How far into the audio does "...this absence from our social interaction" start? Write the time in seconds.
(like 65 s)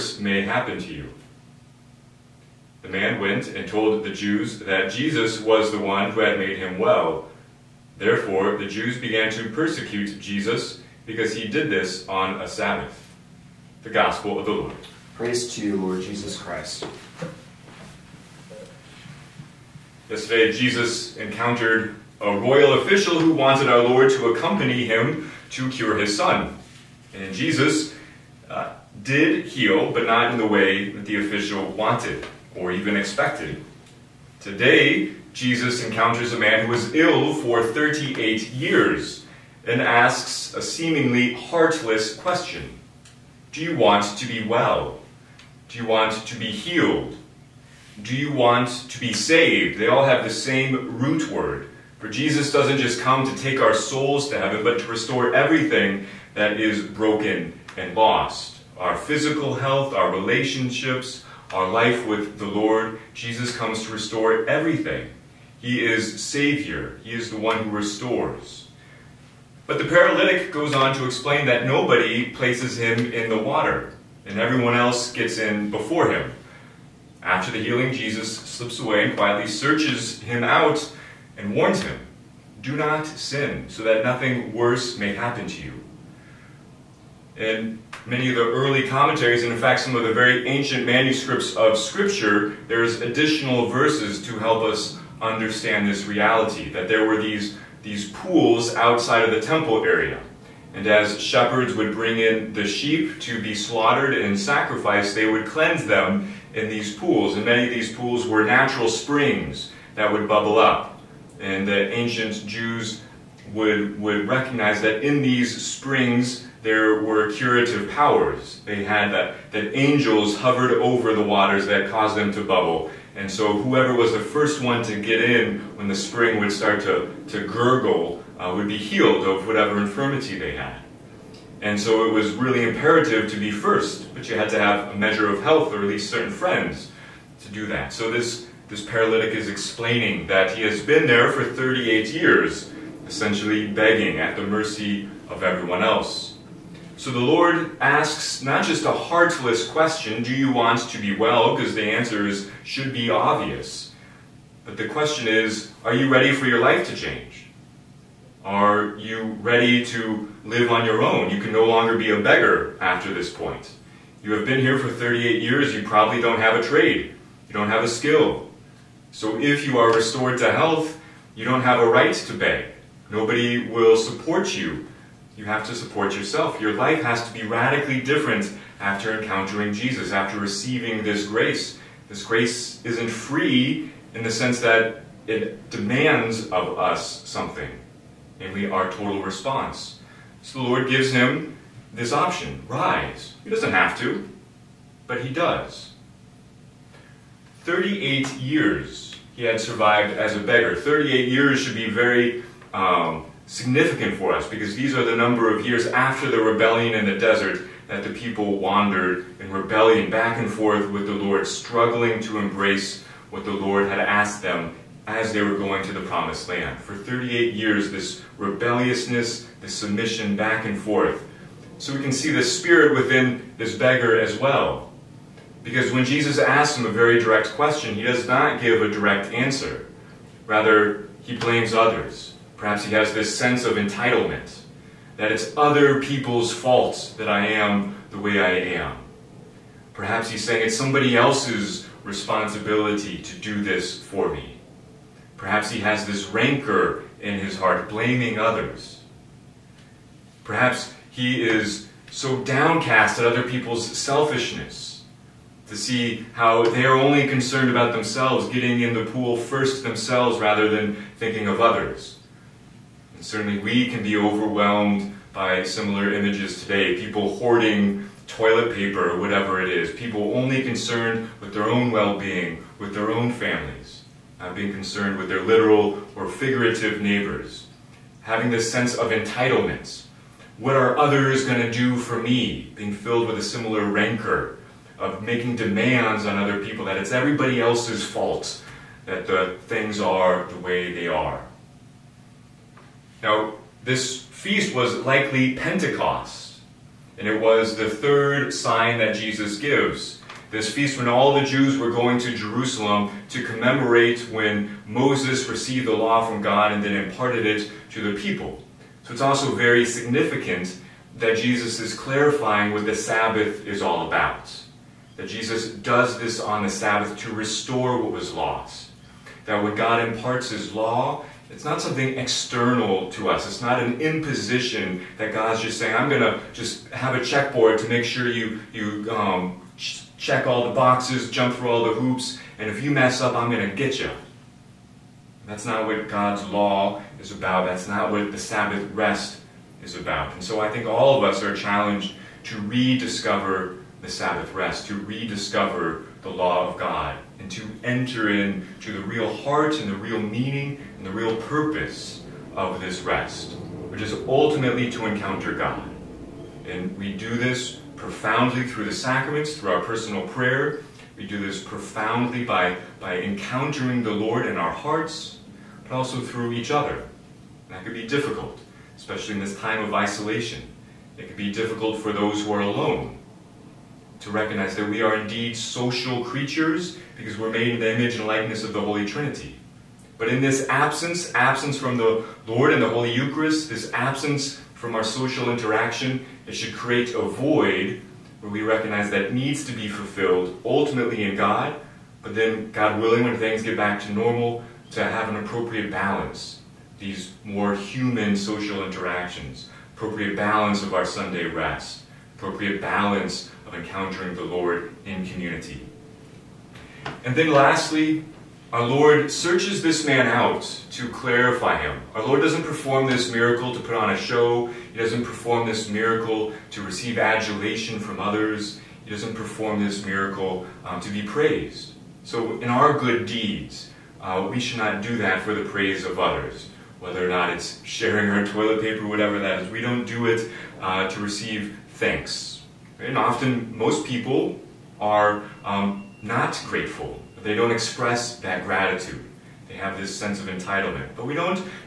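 383 s.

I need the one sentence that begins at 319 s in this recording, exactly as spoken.
That when God imparts his law, it's not something external to us.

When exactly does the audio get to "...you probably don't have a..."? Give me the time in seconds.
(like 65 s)
165 s.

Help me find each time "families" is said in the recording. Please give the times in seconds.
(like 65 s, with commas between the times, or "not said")
273 s.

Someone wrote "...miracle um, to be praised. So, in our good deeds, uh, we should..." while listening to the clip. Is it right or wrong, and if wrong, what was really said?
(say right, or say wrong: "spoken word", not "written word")
right.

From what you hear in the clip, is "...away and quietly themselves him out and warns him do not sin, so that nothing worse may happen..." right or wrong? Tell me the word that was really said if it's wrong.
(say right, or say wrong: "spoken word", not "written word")
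wrong: "searches", not "themselves".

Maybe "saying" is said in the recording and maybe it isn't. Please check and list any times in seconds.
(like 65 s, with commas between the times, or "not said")
240 s, 325 s.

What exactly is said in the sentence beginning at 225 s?
Because when Jesus asks him a very direct question, he does not give a direct answer.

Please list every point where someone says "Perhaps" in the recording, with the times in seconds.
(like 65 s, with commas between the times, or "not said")
232 s, 239 s, 245 s, 250 s.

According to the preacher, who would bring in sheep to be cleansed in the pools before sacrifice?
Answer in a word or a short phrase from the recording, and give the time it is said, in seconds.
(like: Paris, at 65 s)
Shepherds, at 101 s.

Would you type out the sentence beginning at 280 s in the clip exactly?
What are others going to do for me?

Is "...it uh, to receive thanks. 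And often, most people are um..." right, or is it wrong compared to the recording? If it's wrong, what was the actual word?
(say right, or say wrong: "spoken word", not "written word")
right.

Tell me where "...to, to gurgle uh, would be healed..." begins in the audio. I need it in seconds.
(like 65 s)
126 s.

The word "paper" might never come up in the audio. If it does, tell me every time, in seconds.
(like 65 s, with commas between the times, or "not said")
268 s, 428 s.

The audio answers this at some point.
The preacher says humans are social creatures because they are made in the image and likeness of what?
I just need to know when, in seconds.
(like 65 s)
378 s.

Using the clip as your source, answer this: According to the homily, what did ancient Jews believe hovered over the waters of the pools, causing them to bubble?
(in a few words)
Angels.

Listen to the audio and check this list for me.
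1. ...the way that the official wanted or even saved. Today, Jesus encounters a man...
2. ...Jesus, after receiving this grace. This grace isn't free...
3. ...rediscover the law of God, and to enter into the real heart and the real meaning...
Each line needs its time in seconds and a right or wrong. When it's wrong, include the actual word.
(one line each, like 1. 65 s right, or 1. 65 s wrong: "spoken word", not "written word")
1. 30 s wrong: "expected", not "saved"
2. 179 s right
3. 345 s right.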